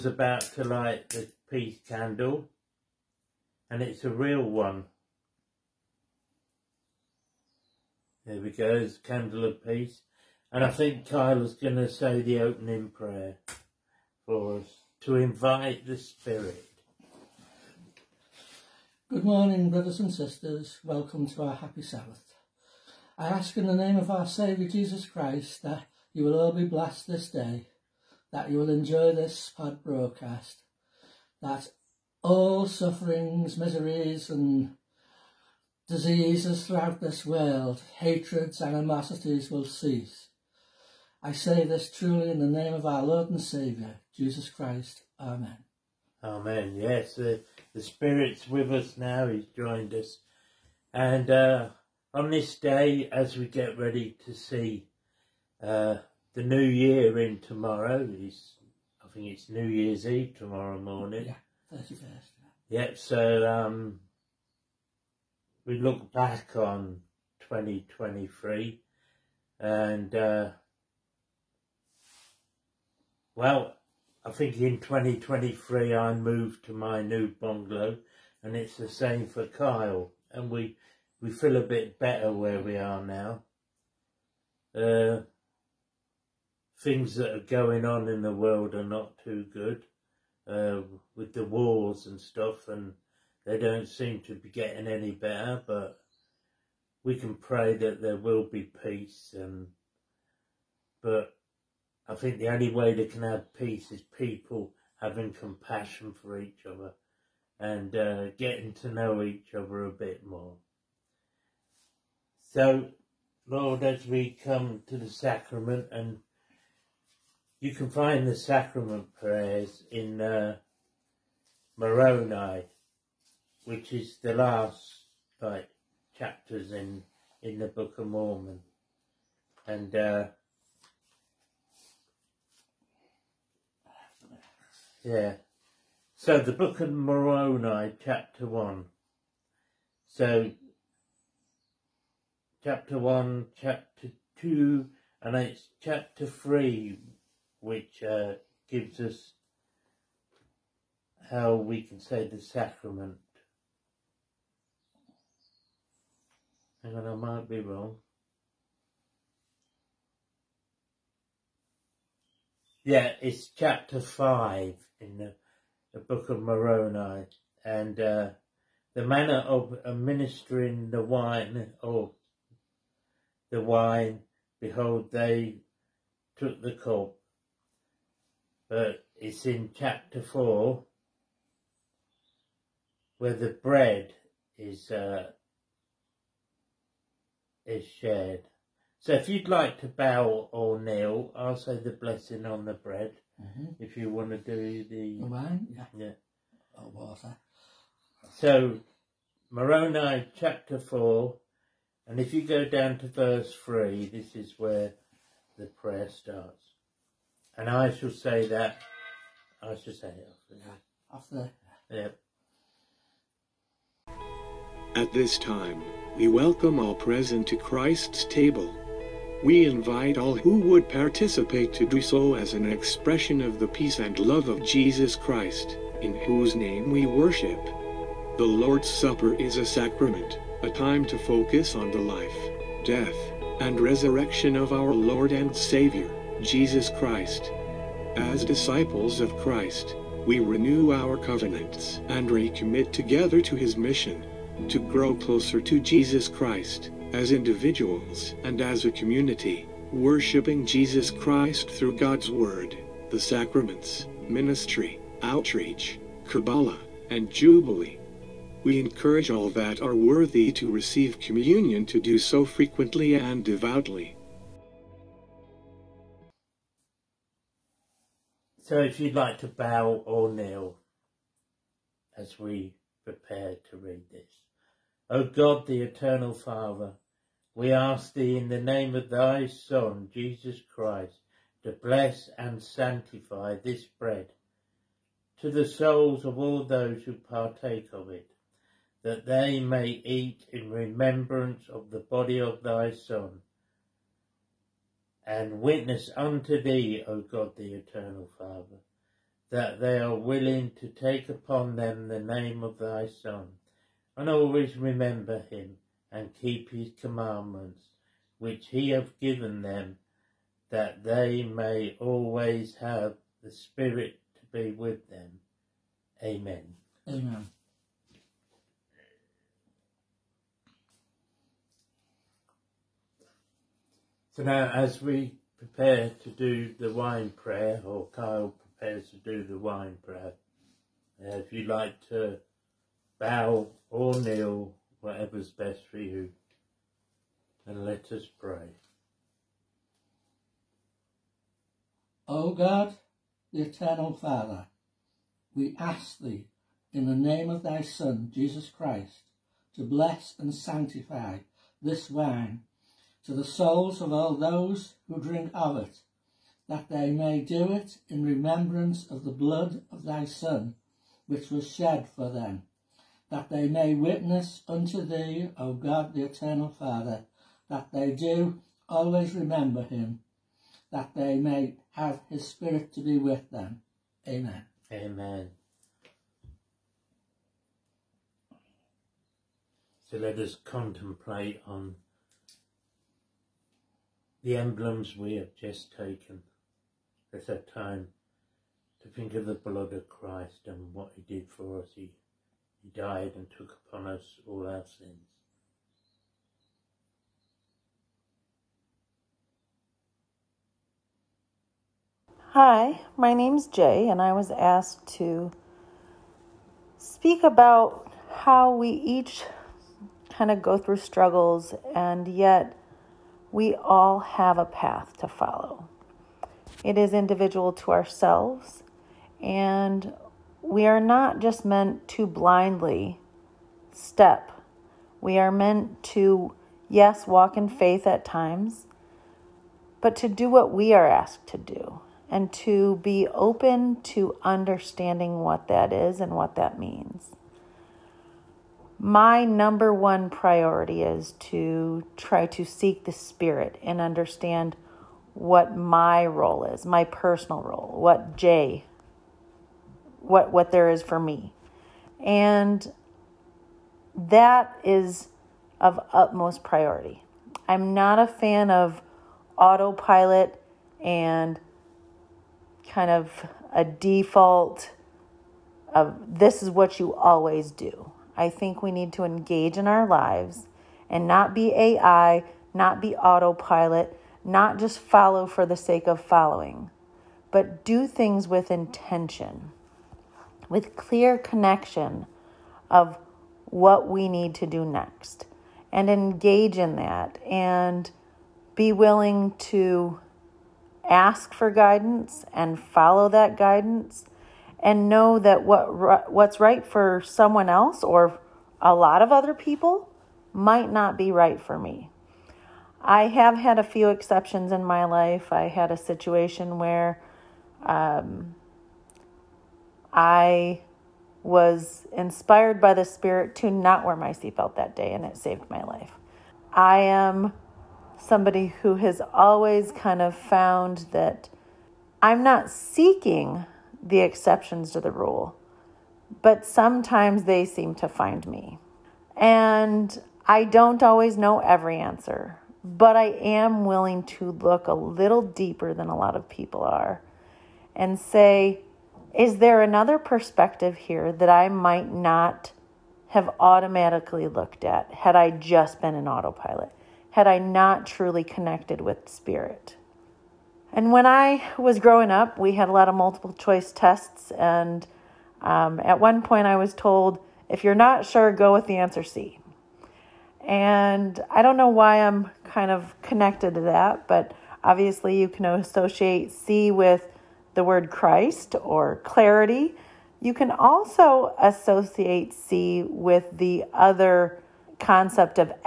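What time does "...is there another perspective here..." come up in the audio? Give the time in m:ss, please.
8:59.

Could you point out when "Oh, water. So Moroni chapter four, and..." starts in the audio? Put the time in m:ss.
3:16.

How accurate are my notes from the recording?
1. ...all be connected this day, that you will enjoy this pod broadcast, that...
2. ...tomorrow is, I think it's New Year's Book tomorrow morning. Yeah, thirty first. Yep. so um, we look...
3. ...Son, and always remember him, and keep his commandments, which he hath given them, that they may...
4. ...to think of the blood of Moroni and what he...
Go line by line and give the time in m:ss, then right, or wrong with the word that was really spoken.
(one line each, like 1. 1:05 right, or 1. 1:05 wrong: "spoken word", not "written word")
1. 0:26 wrong: "blessed", not "connected"
2. 0:57 wrong: "Eve", not "Book"
3. 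5:03 right
4. 6:29 wrong: "Christ", not "Moroni".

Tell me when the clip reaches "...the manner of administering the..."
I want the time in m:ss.
2:48.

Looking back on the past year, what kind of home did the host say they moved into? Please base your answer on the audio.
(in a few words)
bungalow.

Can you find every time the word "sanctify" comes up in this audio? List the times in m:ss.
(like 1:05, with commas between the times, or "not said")
4:42, 5:50.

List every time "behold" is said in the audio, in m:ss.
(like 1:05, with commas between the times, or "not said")
2:54.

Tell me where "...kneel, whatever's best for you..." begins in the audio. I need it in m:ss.
5:34.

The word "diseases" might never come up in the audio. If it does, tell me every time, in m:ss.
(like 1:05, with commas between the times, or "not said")
0:35.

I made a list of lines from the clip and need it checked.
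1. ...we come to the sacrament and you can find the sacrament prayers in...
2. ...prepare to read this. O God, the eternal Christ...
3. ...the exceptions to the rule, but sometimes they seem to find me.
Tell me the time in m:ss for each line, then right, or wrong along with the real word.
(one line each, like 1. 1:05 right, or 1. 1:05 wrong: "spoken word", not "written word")
1. 1:54 right
2. 4:33 wrong: "Father", not "Christ"
3. 8:44 right.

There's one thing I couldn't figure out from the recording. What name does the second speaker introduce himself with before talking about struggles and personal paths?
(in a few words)
Jay.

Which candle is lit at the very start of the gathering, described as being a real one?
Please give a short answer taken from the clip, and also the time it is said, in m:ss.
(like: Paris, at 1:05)
peace candle, at 0:01.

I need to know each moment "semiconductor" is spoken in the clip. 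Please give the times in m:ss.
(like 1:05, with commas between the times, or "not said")
not said.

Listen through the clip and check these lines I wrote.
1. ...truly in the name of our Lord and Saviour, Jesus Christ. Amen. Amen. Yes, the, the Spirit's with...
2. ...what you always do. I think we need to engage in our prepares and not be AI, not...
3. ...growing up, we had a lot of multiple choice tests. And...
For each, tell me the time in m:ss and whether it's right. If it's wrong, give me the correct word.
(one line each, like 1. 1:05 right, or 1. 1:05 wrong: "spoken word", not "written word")
1. 0:41 right
2. 7:46 wrong: "lives", not "prepares"
3. 9:11 right.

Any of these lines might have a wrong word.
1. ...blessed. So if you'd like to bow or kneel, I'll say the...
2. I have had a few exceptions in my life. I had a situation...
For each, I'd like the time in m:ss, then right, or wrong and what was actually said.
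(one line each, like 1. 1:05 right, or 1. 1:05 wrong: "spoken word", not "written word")
1. 3:07 wrong: "shared", not "blessed"
2. 8:22 right.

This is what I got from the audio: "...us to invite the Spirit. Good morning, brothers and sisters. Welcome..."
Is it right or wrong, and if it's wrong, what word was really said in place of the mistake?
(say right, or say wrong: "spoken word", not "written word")
right.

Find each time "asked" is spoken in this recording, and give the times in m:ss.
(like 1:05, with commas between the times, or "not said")
6:44, 7:11.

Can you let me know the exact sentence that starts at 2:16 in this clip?
So the Book of Moroni, chapter one.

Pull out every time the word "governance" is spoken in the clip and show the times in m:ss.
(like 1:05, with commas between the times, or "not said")
not said.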